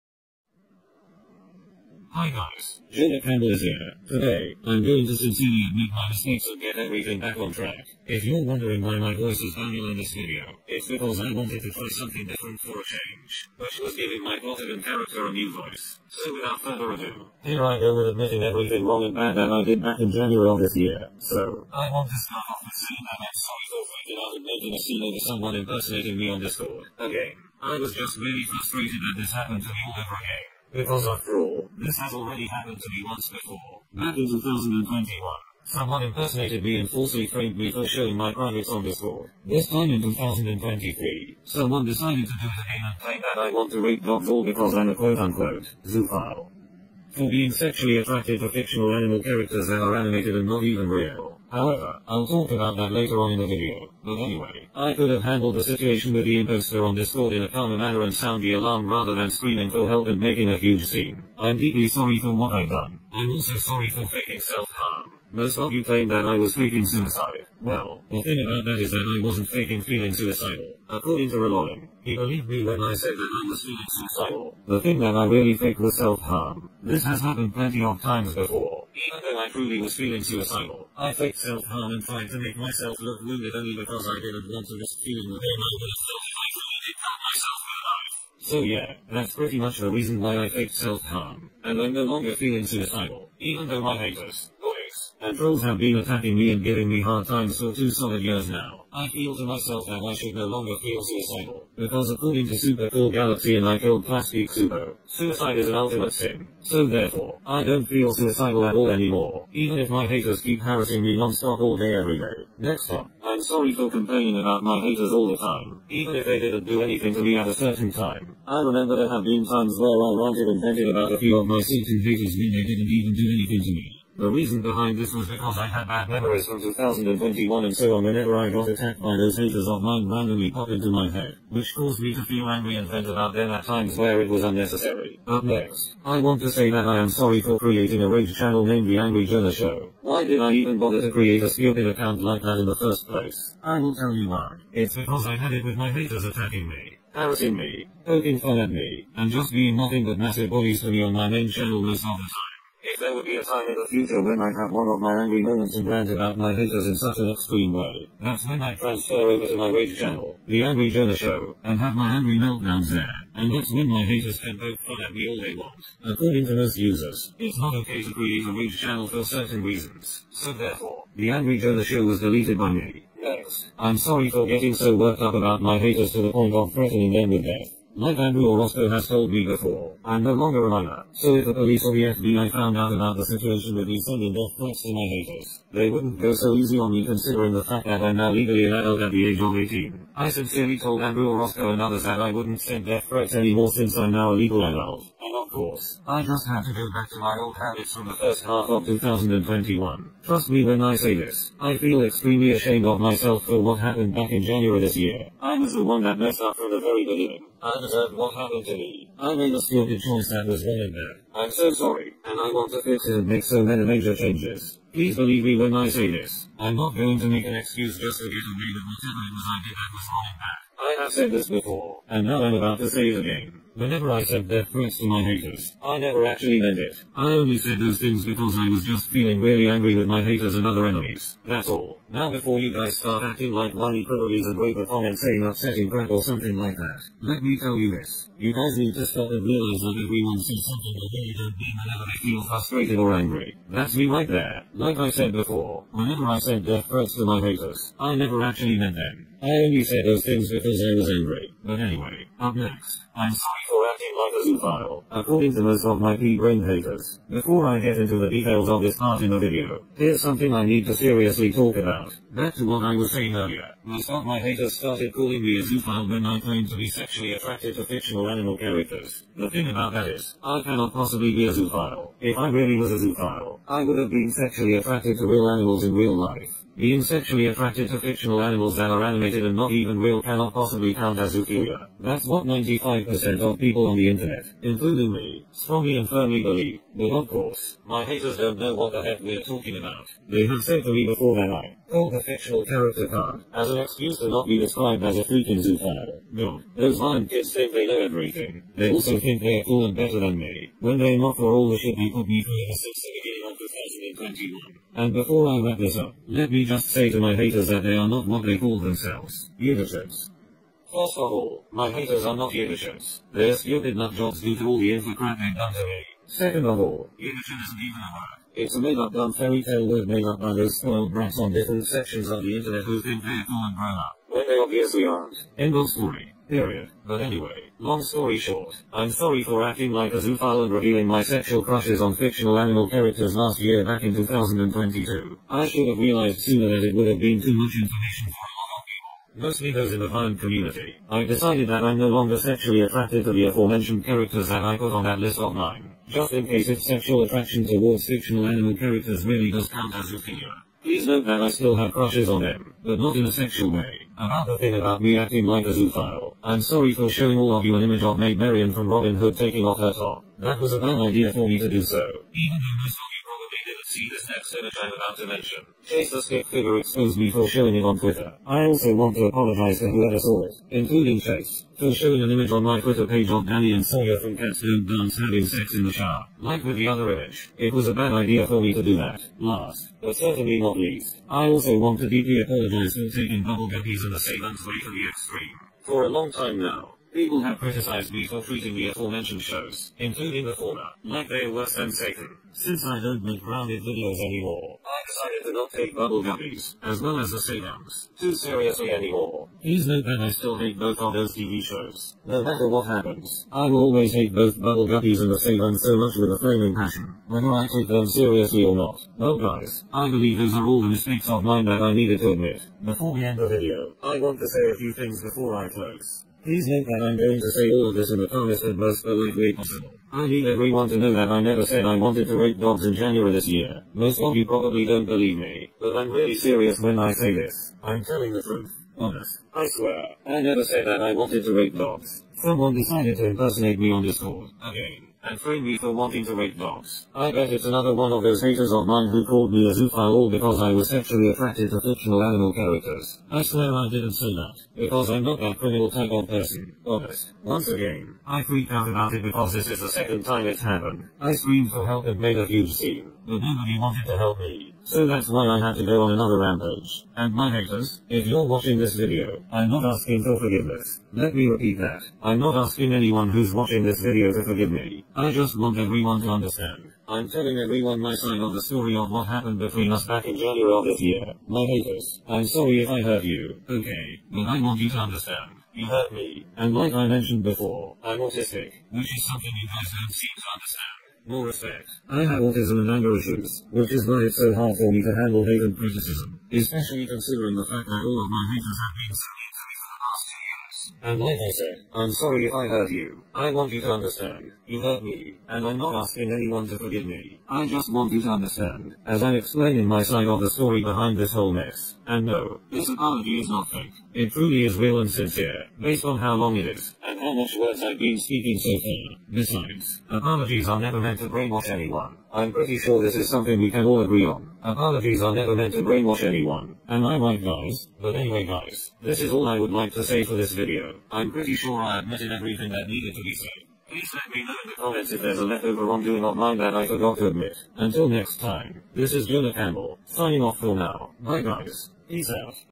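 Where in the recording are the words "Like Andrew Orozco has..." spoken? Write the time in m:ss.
2:57.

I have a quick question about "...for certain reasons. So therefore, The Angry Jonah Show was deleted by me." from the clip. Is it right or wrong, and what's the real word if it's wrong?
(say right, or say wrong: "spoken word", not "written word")
right.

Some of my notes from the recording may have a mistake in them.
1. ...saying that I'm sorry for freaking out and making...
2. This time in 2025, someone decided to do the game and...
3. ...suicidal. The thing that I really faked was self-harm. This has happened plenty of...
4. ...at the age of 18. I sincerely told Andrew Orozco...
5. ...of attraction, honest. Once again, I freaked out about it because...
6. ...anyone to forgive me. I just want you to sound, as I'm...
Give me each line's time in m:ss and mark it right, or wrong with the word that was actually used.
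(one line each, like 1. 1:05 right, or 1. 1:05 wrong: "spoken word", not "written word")
1. 0:22 right
2. 0:39 wrong: "2023", not "2025"
3. 1:13 right
4. 3:09 right
5. 7:26 wrong: "person", not "attraction"
6. 8:16 wrong: "understand", not "sound".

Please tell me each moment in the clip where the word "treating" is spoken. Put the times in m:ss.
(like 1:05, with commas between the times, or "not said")
6:28.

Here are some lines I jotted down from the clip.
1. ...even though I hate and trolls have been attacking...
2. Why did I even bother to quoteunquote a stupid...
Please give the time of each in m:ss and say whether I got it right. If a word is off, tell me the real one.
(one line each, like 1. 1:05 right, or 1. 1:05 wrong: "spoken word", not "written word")
1. 1:33 right
2. 2:20 wrong: "create", not "quoteunquote".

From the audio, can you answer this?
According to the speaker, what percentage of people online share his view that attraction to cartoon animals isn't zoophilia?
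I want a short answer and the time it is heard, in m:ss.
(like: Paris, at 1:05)
95%, at 4:42.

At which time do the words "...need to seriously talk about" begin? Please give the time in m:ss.
4:20.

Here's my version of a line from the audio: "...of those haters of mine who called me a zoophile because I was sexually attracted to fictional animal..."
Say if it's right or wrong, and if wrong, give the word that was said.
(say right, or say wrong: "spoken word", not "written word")
right.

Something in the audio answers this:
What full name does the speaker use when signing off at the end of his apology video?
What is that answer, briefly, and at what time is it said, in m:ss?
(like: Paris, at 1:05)
Jonah Campbell, at 8:49.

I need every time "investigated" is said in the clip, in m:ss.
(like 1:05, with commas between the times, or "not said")
not said.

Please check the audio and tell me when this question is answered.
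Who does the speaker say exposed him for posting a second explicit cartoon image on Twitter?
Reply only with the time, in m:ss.
6:05.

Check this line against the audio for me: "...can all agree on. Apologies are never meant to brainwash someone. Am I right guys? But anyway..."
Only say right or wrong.
wrong.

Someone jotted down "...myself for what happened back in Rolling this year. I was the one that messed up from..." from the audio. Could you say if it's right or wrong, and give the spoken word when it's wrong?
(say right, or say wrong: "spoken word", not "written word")
wrong: "January", not "Rolling".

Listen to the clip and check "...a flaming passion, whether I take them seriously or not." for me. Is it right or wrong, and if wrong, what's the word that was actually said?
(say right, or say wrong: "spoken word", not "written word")
right.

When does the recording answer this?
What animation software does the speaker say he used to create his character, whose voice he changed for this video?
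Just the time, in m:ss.
0:14.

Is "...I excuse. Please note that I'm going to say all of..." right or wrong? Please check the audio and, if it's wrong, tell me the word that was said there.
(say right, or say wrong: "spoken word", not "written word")
wrong: "close", not "excuse".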